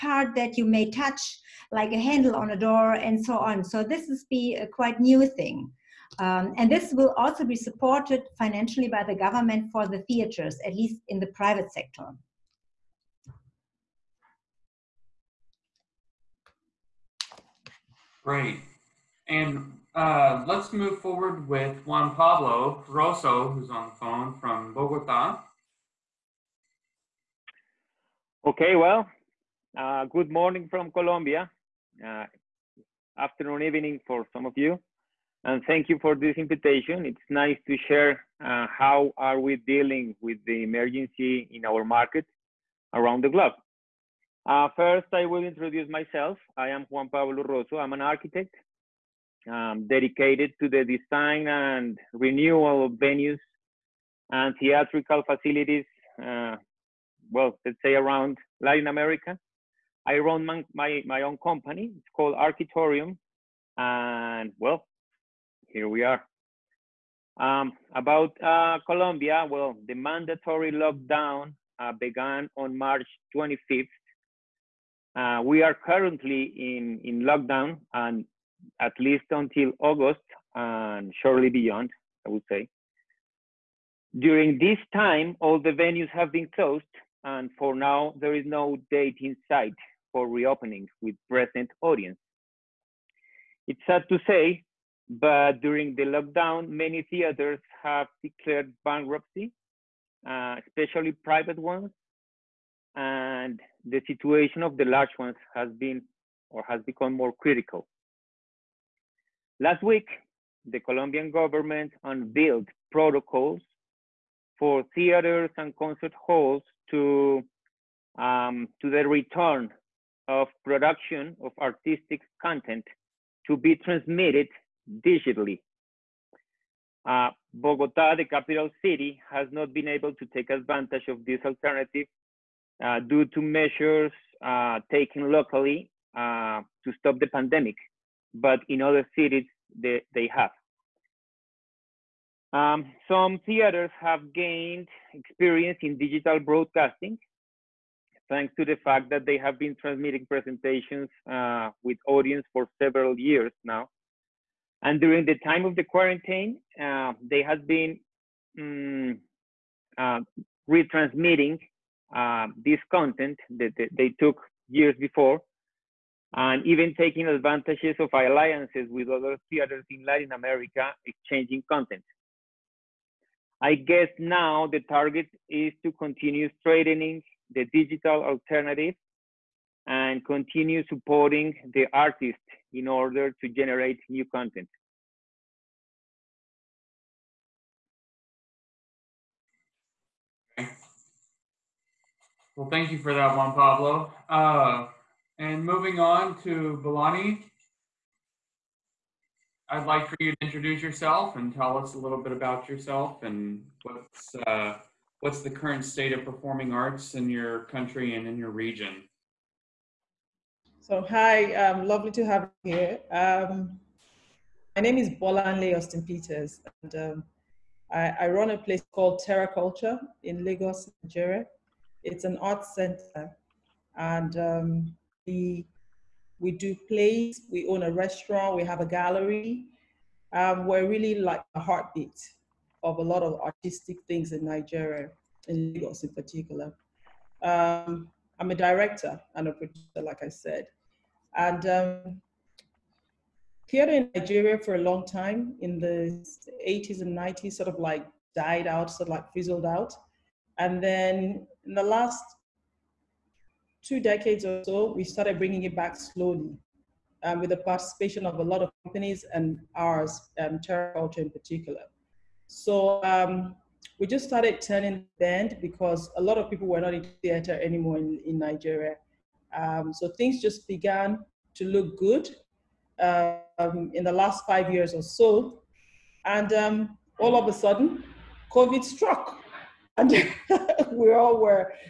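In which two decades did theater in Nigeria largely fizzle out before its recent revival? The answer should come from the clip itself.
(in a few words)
80s and 90s.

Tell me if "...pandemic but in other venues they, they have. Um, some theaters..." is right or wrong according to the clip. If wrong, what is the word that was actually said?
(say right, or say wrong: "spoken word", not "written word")
wrong: "cities", not "venues".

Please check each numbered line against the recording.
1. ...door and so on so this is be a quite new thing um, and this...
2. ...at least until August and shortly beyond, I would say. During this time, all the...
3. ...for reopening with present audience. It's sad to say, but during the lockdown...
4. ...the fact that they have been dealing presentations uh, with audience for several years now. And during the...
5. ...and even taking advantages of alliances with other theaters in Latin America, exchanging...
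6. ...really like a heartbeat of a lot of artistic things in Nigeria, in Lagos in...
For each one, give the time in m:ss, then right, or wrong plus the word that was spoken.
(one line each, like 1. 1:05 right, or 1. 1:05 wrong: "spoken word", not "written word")
1. 0:02 right
2. 1:18 right
3. 1:30 right
4. 2:28 wrong: "transmitting", not "dealing"
5. 2:46 right
6. 3:50 right.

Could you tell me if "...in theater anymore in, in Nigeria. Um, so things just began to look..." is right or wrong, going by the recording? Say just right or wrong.
right.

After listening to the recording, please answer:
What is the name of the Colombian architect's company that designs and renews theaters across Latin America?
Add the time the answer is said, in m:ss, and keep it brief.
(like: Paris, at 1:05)
Arquitorium, at 1:02.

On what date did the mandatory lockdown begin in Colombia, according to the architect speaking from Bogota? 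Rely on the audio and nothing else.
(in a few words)
March 25th.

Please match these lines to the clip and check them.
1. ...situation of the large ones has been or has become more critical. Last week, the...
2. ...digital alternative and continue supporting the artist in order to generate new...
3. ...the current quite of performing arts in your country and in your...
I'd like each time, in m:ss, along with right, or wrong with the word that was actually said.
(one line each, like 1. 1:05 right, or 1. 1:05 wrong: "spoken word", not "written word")
1. 1:44 right
2. 2:57 right
3. 3:25 wrong: "state", not "quite".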